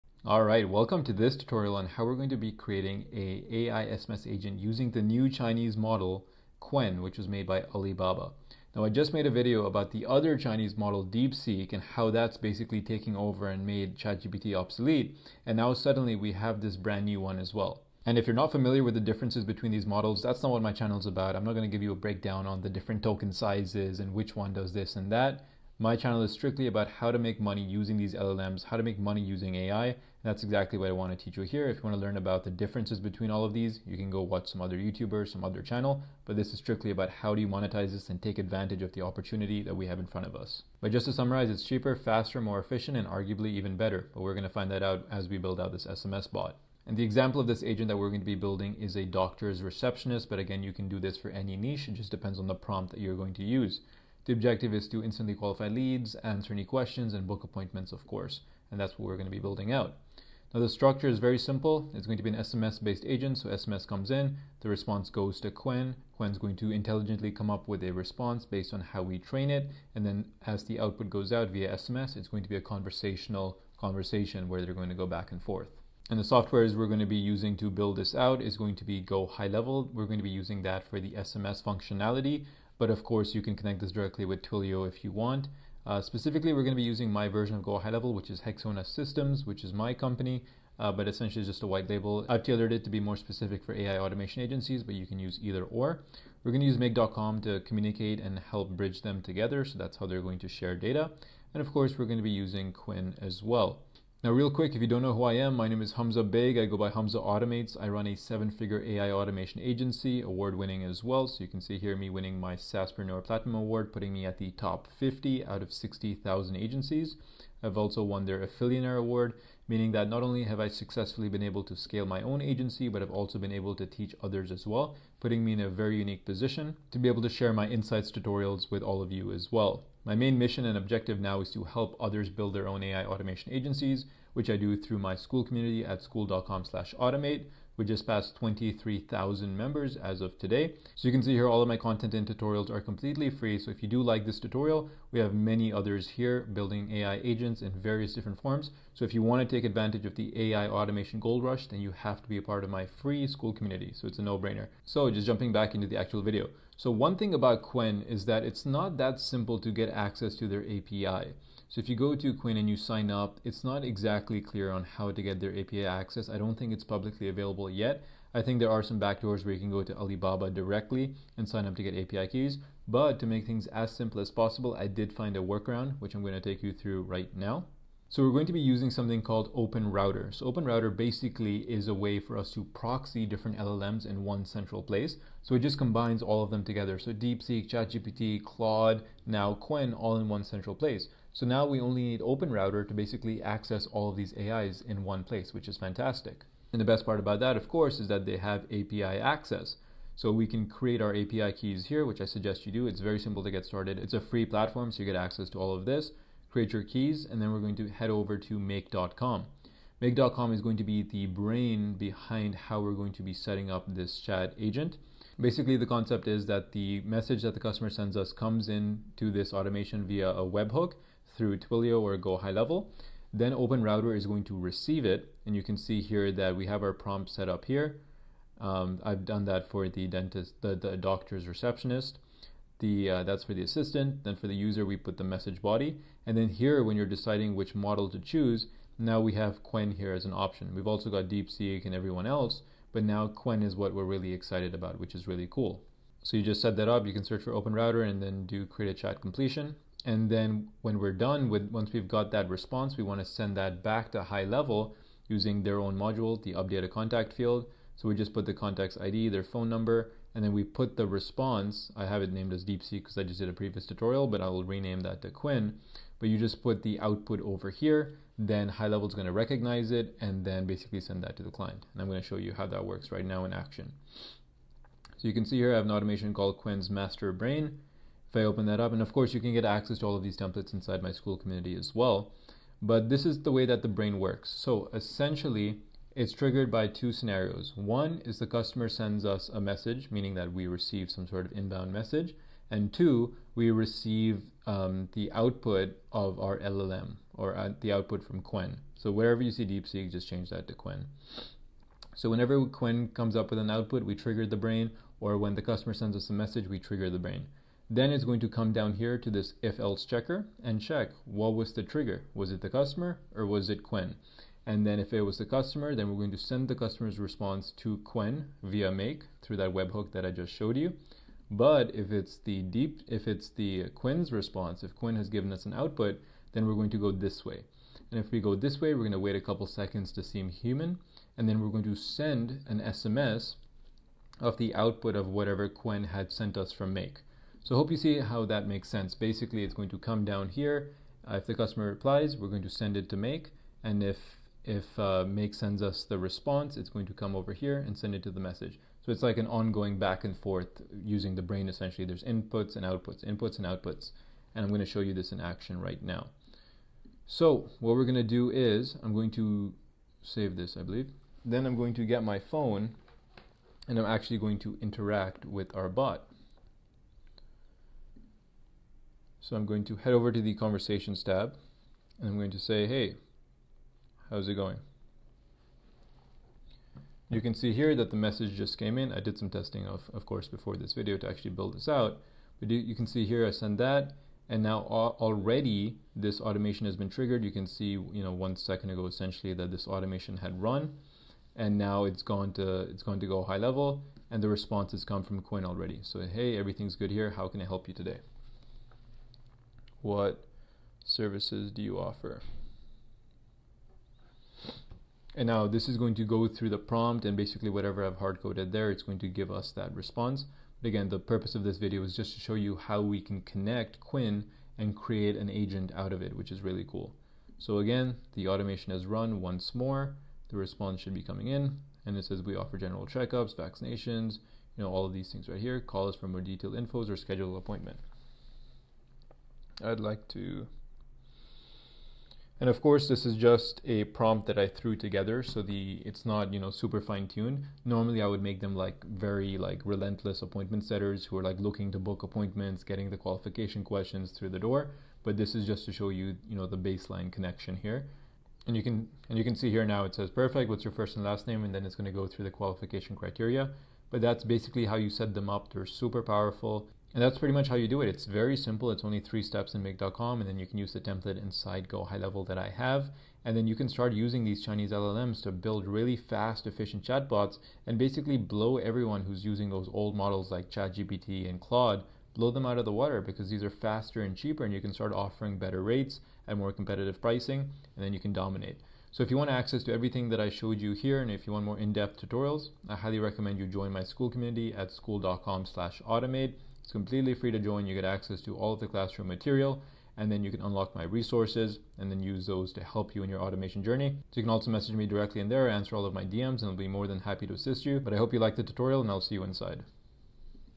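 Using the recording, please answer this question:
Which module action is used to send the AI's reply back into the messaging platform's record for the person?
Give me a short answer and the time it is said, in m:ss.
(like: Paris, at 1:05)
Update a contact field, at 4:16.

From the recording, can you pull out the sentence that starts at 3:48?
Um, I've done that for the dentist, the, the doctor's receptionist.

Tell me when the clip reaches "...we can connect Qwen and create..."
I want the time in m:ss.
6:53.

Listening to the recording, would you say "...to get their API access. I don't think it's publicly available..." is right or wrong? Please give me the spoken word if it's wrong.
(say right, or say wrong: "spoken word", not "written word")
right.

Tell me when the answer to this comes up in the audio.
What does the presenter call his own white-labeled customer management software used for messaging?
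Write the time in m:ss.
1:28.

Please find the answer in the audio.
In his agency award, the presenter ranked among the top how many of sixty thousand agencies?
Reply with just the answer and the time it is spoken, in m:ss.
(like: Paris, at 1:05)
50, at 1:54.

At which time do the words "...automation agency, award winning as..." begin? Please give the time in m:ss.
1:49.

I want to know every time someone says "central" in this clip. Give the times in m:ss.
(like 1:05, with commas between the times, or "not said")
3:04, 3:10.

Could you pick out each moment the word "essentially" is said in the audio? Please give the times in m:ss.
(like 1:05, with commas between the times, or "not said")
1:31, 4:44, 5:51, 6:29.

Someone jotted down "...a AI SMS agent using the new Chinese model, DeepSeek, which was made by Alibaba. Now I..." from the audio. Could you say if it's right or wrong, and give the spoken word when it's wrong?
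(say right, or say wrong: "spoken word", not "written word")
wrong: "Qwen", not "DeepSeek".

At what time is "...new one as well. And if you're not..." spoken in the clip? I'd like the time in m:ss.
0:17.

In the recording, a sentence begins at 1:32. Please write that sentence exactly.
I've tailored it to be more specific for AI automation agencies, but you can use either or.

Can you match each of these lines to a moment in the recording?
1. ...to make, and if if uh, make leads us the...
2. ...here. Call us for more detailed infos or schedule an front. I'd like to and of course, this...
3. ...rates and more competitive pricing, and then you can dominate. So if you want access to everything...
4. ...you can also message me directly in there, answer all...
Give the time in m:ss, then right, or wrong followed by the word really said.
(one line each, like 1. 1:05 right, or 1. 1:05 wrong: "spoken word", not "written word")
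1. 5:43 wrong: "sends", not "leads"
2. 7:05 wrong: "appointment", not "front"
3. 7:55 right
4. 8:14 right.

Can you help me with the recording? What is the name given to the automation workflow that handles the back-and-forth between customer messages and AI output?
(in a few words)
Qwen's Master Brain.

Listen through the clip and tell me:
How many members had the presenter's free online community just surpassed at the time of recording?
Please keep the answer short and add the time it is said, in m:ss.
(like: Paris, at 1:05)
23,000, at 2:18.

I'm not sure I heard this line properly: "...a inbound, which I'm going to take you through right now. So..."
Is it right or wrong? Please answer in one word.
wrong.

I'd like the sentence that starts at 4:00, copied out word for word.
We've also got DeepSeek and everyone else.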